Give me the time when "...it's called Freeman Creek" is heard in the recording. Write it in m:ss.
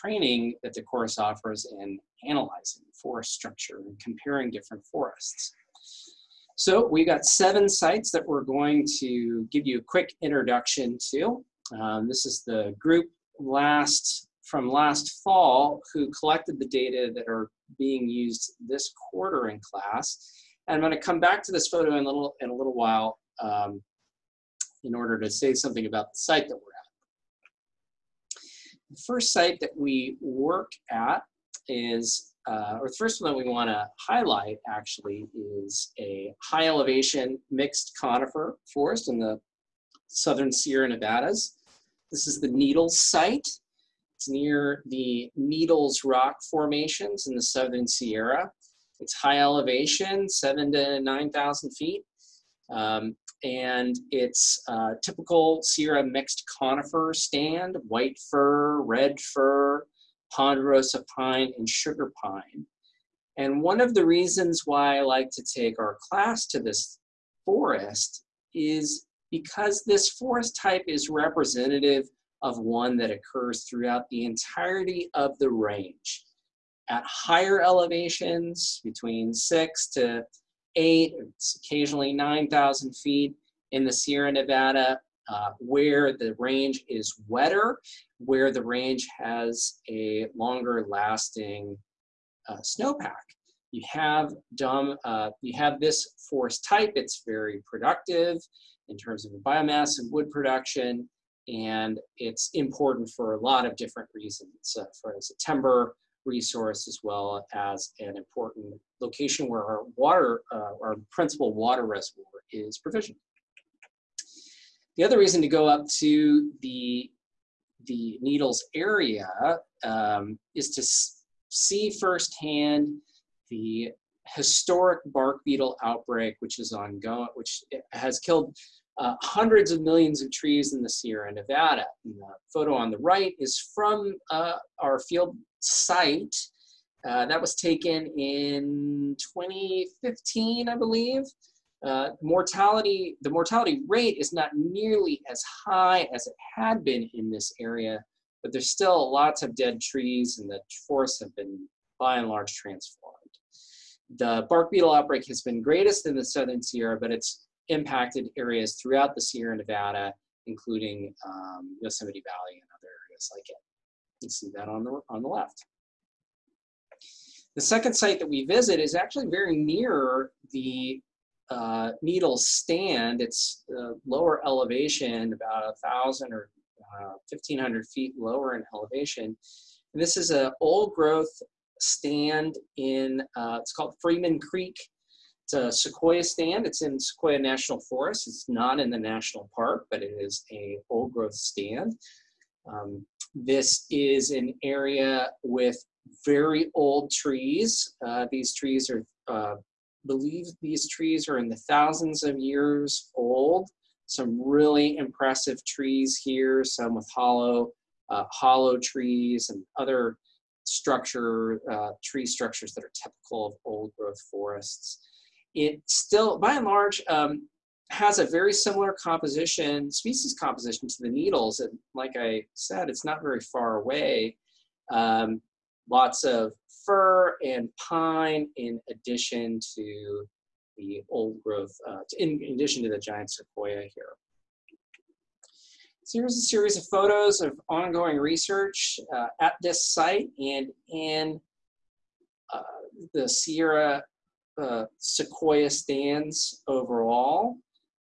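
3:03.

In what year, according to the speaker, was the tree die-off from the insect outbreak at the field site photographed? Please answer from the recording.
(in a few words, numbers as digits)
2015.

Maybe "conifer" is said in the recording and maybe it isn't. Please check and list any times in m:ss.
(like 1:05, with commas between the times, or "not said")
0:37, 0:56.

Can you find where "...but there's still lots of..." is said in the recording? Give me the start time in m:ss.
2:28.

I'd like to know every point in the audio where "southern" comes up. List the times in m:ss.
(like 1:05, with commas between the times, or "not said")
0:40, 0:47, 2:36.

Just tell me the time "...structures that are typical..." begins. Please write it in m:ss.
3:32.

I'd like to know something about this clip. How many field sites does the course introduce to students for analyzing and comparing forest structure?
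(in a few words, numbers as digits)
7.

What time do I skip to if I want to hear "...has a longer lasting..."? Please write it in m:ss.
1:29.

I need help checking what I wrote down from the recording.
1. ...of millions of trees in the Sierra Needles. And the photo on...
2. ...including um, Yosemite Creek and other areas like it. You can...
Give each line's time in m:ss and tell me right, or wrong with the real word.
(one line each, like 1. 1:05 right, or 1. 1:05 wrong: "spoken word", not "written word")
1. 2:09 wrong: "Nevada", not "Needles"
2. 2:40 wrong: "Valley", not "Creek".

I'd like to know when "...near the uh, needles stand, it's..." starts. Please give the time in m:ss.
2:49.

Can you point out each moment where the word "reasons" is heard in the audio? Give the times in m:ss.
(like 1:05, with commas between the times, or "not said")
1:04, 1:44, 1:55.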